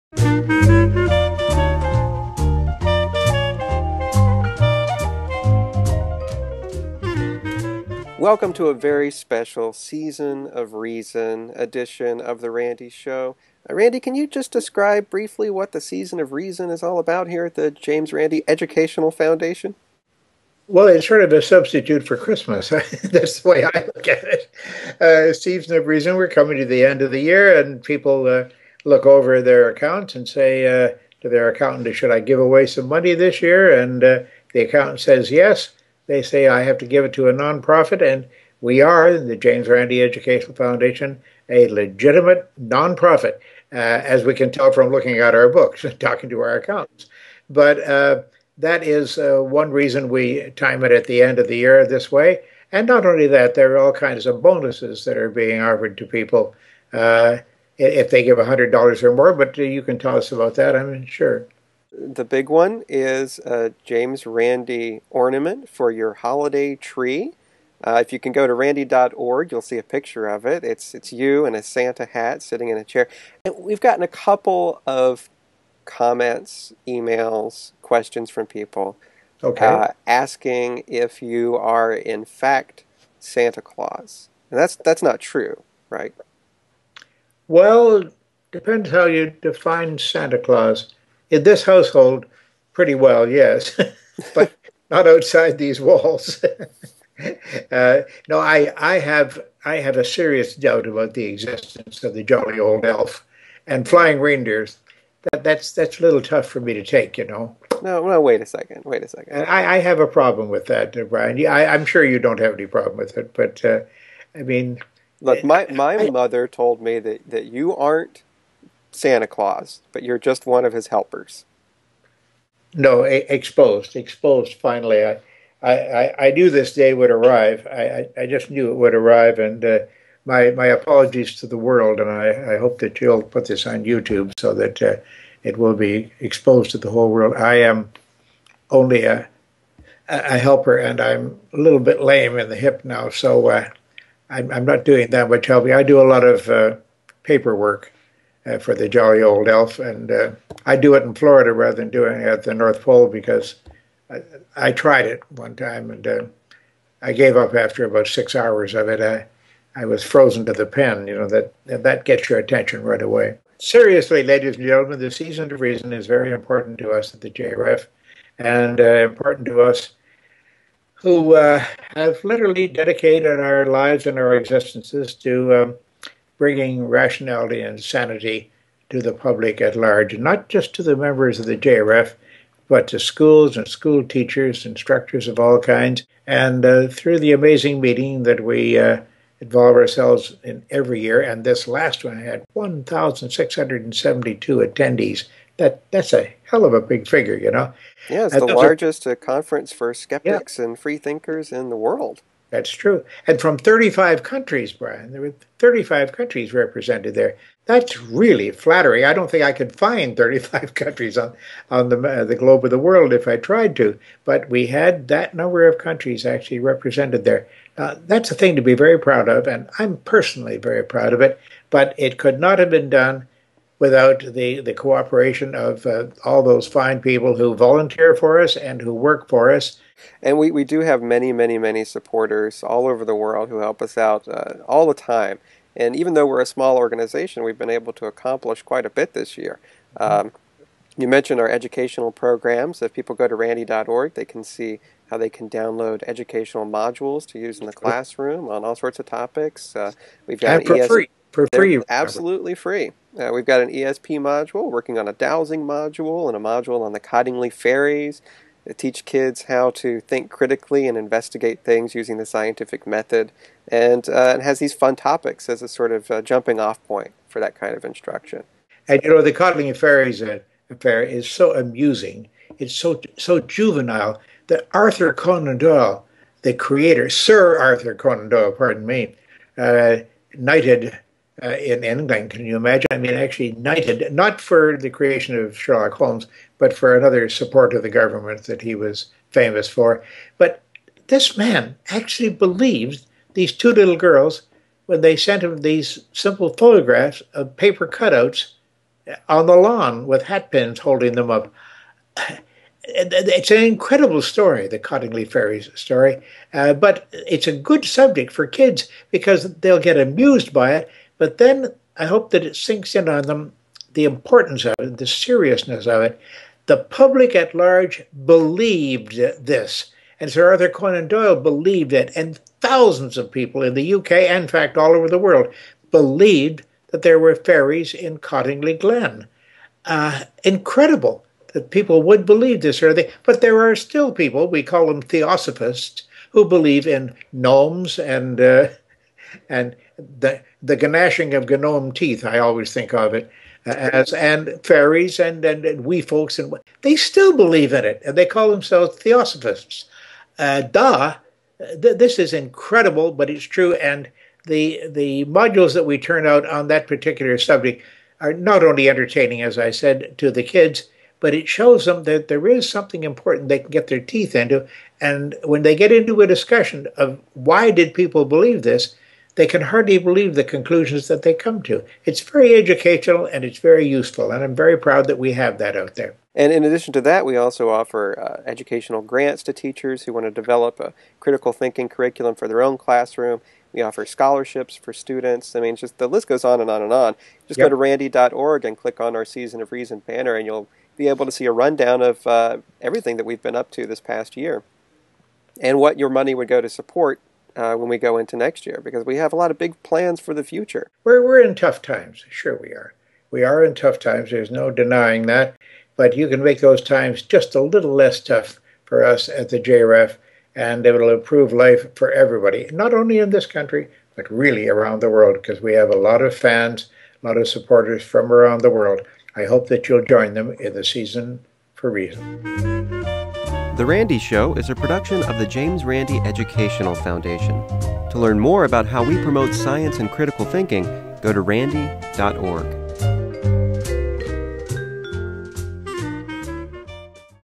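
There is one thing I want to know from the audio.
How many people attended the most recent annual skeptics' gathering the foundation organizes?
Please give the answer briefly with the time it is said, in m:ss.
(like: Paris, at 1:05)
1,672, at 3:12.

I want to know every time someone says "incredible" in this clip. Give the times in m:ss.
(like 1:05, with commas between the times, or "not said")
5:03, 5:30, 5:52.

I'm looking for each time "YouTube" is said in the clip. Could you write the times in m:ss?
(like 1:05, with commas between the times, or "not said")
2:13.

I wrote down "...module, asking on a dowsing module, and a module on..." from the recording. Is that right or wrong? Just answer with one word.
wrong.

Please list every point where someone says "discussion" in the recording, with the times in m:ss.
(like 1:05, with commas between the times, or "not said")
6:06.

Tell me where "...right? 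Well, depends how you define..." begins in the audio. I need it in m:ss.
1:25.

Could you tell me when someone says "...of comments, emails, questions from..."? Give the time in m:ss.
1:14.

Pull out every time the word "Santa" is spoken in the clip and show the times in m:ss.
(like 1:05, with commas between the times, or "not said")
1:11, 1:23, 1:29, 1:58.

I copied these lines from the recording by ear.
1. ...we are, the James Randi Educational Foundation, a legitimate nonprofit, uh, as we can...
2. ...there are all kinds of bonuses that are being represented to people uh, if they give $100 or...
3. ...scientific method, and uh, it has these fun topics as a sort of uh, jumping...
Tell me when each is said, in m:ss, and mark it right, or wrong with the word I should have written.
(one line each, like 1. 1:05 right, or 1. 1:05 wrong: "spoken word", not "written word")
1. 0:38 right
2. 0:53 wrong: "offered", not "represented"
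3. 4:22 right.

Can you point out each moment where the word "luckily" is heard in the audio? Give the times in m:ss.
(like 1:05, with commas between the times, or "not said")
not said.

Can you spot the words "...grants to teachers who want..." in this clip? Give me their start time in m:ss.
6:19.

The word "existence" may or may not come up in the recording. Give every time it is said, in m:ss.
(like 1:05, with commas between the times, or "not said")
1:41, 2:54.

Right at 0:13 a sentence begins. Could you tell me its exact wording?
Uh, Randi, can you just describe briefly what the Season of Reason is all about here at the James Randi Educational Foundation?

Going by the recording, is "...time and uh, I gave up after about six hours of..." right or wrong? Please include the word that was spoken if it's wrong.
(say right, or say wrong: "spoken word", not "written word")
right.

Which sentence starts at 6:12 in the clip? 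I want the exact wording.
It's very educational and it's very useful, and I'm very proud that we have that out there.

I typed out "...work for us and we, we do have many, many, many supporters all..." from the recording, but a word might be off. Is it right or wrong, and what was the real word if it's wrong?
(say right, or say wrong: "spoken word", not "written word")
right.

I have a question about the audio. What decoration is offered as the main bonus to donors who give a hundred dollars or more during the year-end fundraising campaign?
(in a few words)
James Randi ornament.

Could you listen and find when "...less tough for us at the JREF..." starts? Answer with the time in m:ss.
6:47.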